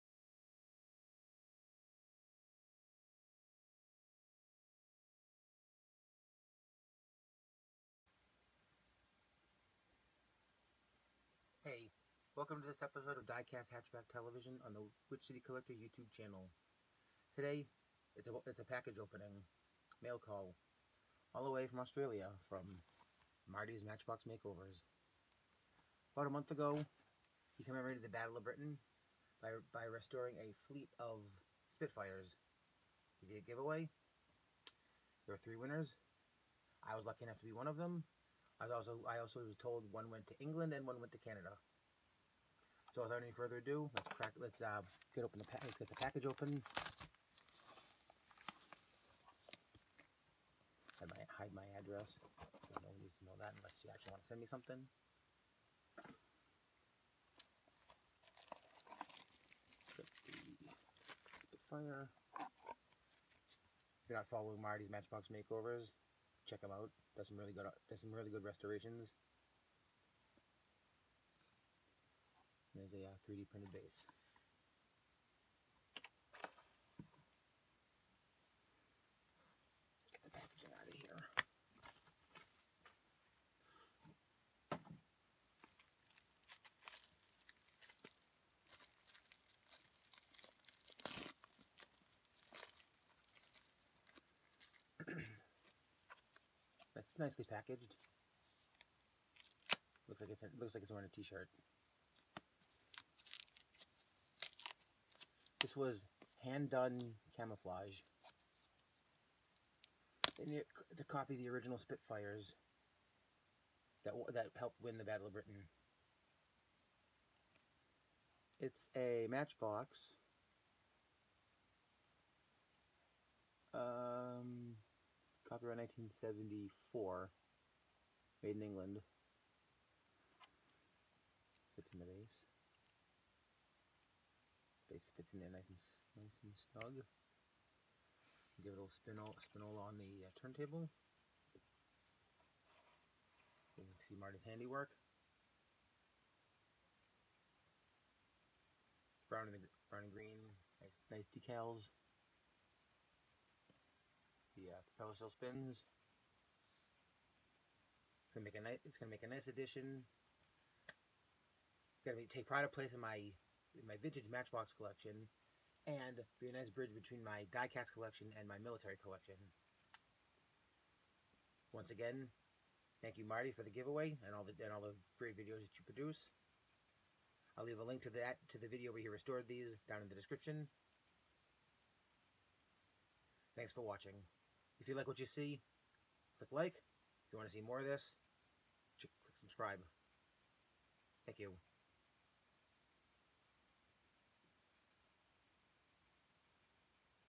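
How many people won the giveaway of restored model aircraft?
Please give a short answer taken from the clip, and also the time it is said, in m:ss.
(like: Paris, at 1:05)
3, at 0:35.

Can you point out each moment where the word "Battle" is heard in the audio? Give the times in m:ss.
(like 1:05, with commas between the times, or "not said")
0:28, 1:55.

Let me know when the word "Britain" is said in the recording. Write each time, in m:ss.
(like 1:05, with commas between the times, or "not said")
0:28, 1:55.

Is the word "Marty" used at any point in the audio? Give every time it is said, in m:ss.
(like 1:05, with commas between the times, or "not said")
0:23, 1:04, 2:24, 2:53.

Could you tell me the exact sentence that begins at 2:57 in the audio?
I'll leave a link to that to the video where he restored these down in the description.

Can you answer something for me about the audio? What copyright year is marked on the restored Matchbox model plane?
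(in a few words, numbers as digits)
1974.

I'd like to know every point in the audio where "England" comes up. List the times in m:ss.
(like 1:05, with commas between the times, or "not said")
0:40, 2:08.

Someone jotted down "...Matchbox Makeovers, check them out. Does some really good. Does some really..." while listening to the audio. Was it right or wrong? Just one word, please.
right.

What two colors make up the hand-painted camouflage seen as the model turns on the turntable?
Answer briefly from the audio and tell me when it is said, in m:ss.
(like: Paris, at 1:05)
Brown and green, at 2:29.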